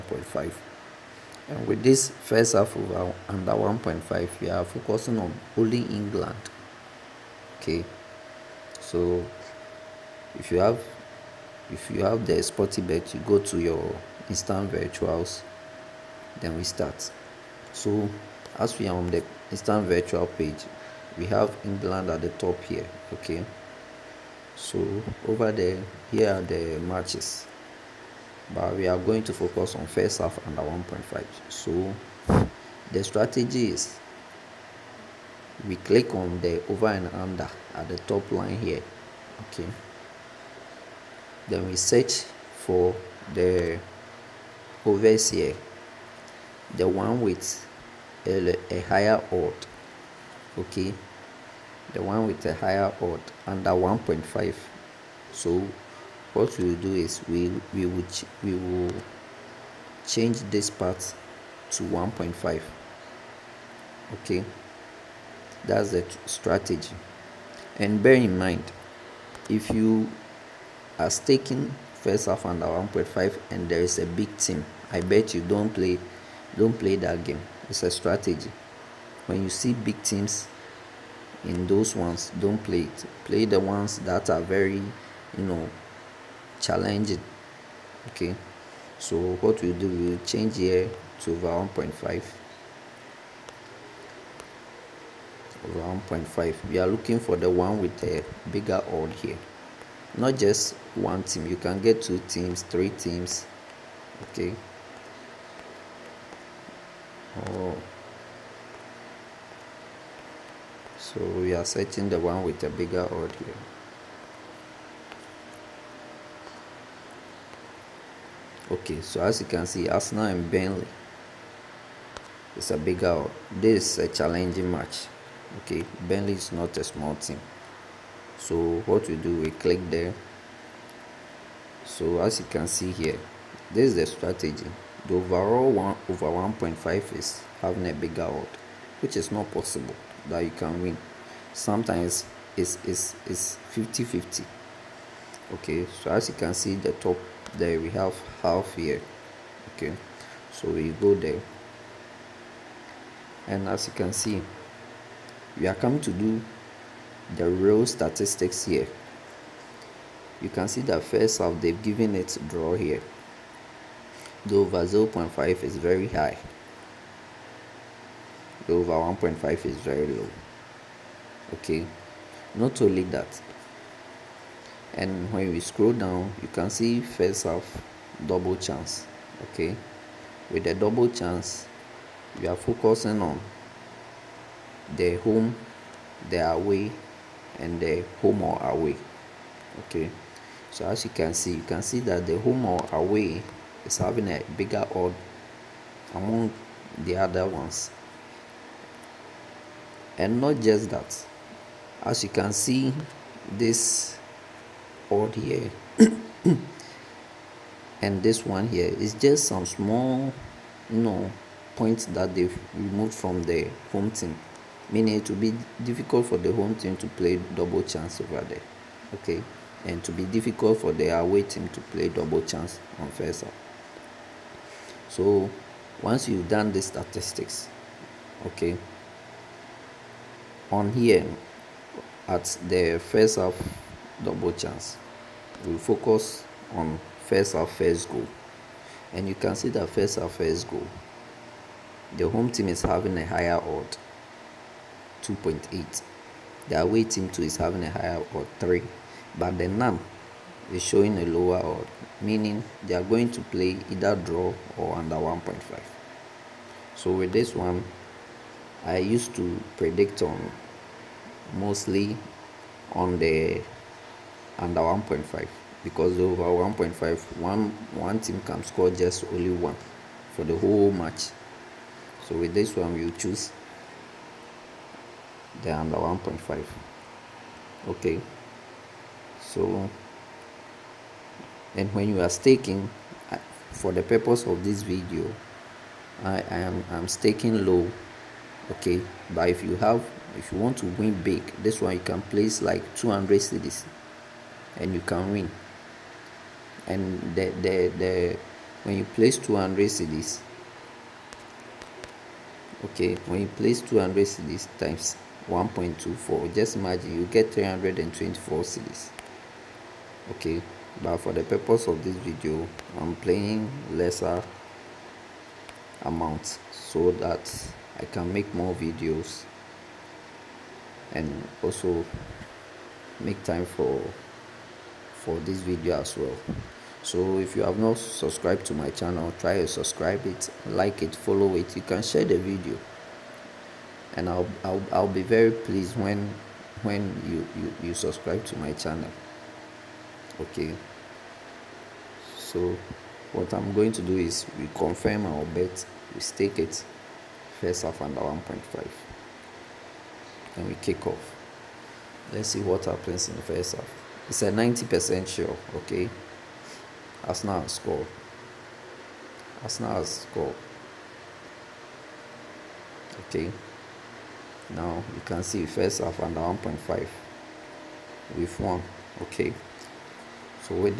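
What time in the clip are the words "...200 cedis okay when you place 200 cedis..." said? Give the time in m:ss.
4:59.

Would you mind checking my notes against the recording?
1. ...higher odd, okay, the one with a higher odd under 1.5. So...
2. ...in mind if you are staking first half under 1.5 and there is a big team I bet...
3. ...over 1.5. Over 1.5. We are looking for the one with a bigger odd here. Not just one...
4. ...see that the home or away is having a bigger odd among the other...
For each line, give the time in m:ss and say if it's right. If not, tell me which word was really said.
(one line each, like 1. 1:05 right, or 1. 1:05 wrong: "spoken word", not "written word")
1. 0:48 right
2. 1:08 right
3. 1:31 right
4. 3:11 right.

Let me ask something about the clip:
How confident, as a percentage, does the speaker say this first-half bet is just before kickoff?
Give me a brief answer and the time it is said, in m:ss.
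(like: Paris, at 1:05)
90 percent, at 5:54.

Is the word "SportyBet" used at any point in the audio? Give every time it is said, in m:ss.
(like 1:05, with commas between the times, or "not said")
0:12.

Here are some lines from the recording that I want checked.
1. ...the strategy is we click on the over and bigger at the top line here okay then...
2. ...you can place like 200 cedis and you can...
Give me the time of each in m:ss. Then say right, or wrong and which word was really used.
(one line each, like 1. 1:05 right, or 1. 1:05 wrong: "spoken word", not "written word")
1. 0:32 wrong: "under", not "bigger"
2. 4:51 right.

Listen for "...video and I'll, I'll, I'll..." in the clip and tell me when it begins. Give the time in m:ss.
5:32.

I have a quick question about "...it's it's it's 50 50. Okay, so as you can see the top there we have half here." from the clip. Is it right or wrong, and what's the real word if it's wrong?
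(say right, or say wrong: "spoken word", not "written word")
right.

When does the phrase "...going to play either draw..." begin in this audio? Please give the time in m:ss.
4:13.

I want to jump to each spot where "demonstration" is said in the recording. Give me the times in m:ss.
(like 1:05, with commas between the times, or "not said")
not said.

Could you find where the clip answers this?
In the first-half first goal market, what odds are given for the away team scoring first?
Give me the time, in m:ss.
4:08.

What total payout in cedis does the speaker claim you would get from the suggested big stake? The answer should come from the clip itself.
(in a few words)
324 cedis.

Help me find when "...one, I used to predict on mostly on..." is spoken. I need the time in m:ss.
4:17.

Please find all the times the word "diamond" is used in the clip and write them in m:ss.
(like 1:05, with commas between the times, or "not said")
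not said.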